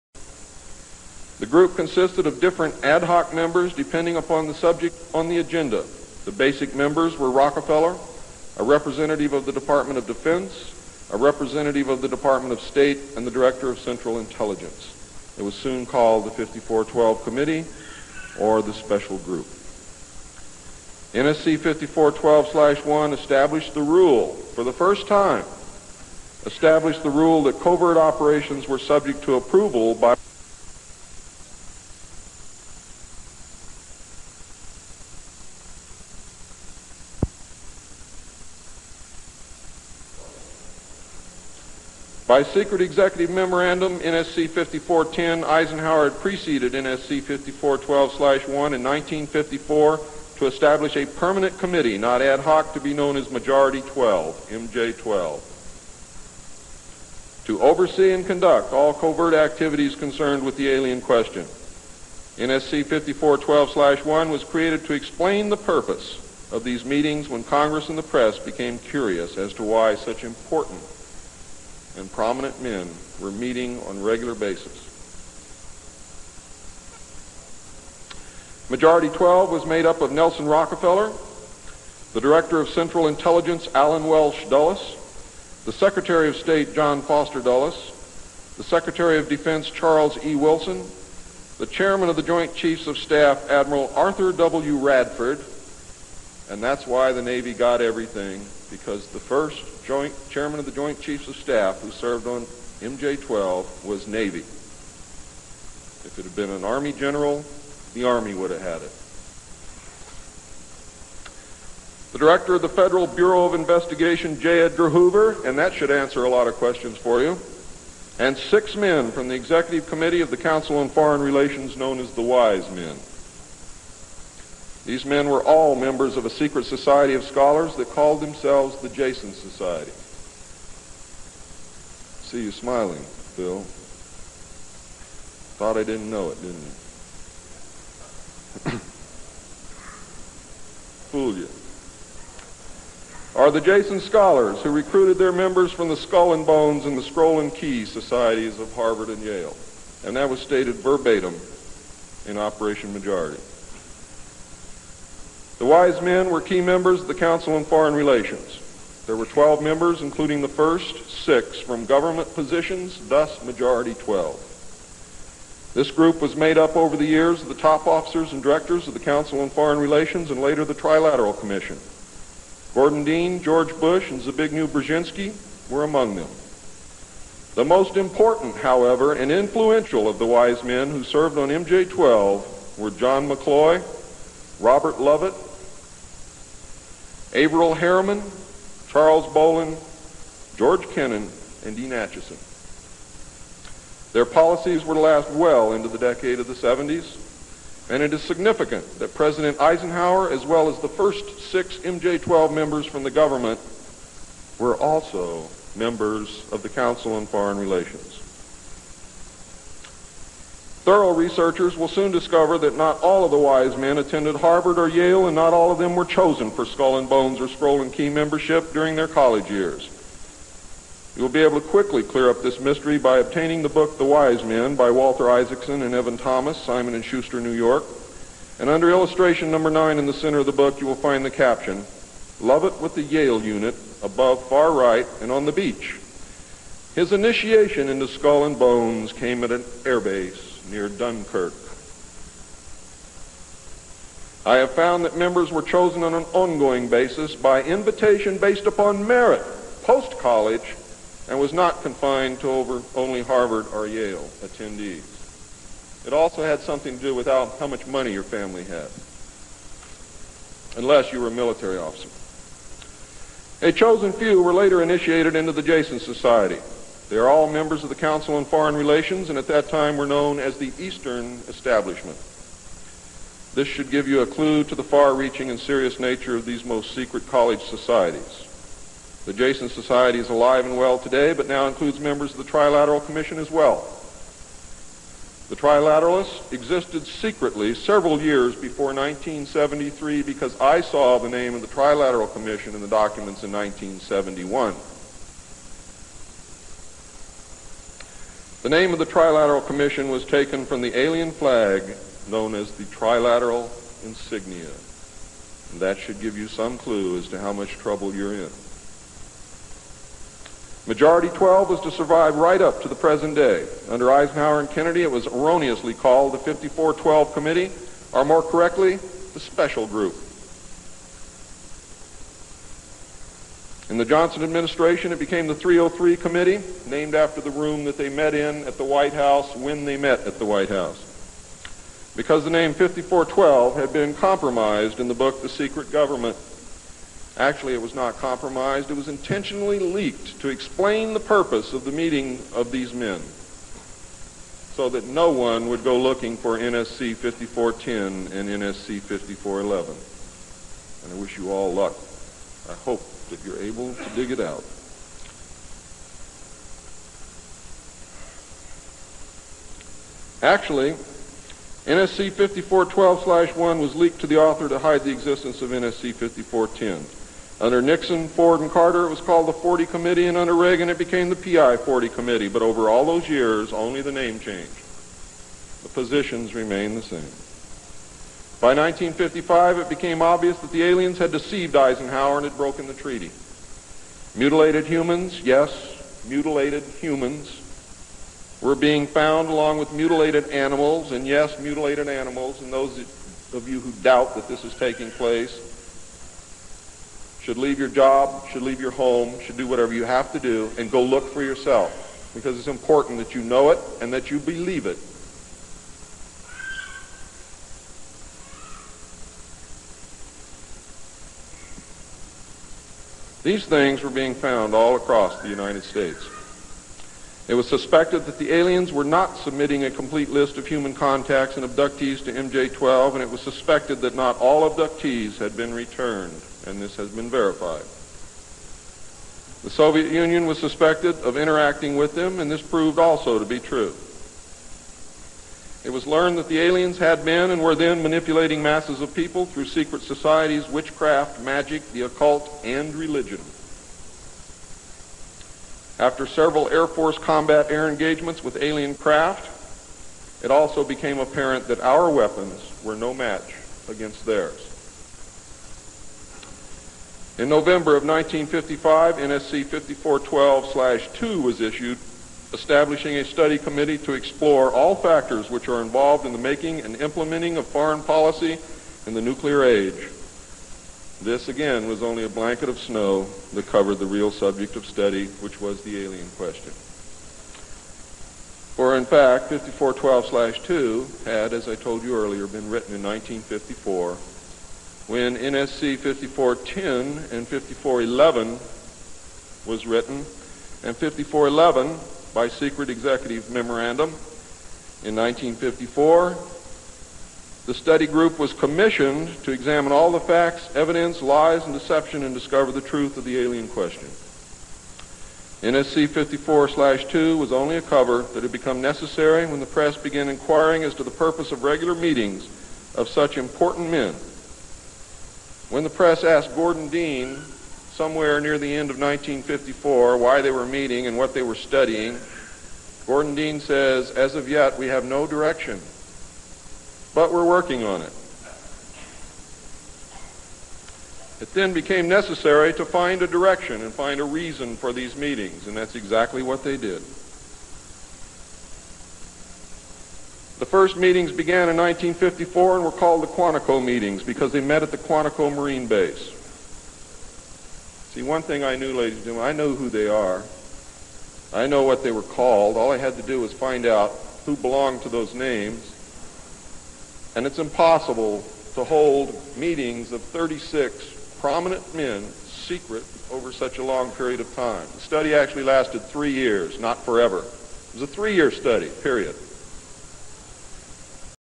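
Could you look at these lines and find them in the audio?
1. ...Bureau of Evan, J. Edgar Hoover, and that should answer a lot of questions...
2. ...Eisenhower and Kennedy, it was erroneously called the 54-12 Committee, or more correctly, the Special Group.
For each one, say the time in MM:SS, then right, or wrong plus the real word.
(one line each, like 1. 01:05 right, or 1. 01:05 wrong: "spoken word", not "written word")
1. 01:53 wrong: "Investigation", not "Evan"
2. 05:14 right.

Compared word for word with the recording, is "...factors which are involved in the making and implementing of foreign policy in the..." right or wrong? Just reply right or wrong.
right.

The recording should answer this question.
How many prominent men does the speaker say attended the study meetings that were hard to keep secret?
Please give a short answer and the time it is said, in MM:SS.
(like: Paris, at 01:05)
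36, at 09:20.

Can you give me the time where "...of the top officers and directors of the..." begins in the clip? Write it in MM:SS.
02:47.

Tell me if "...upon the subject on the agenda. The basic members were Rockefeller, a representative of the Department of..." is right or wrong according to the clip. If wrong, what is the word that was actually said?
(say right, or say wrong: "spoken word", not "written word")
right.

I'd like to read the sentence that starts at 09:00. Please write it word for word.
The first meetings began in 1954 and were called the Quantico meetings because they met at the Quantico Marine Base.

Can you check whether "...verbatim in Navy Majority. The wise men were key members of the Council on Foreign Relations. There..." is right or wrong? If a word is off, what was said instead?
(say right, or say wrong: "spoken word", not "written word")
wrong: "Operation", not "Navy".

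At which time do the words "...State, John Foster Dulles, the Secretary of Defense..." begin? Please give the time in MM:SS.
01:26.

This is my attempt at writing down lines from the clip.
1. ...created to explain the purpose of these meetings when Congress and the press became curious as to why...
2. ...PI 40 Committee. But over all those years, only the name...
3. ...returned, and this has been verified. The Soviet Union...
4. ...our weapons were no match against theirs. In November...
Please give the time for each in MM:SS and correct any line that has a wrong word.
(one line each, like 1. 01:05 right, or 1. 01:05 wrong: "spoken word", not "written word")
1. 01:04 right
2. 06:11 right
3. 07:05 right
4. 07:31 right.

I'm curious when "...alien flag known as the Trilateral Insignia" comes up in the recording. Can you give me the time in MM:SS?
05:00.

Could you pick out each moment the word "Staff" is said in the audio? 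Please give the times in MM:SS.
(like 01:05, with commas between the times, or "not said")
01:32, 01:41.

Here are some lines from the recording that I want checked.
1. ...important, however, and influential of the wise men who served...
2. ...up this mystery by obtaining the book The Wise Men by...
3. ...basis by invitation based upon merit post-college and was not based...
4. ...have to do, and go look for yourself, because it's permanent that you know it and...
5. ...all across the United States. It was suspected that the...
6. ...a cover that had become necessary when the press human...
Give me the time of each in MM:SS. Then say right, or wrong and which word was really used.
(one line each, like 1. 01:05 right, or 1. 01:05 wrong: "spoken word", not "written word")
1. 02:57 right
2. 03:42 right
3. 04:06 wrong: "confined", not "based"
4. 06:40 wrong: "important", not "permanent"
5. 06:54 right
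6. 08:27 wrong: "began", not "human".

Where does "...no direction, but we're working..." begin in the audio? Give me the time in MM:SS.
08:45.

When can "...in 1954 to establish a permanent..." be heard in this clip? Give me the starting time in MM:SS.
00:48.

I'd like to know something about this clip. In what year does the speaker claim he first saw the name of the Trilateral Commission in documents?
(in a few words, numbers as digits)
1971.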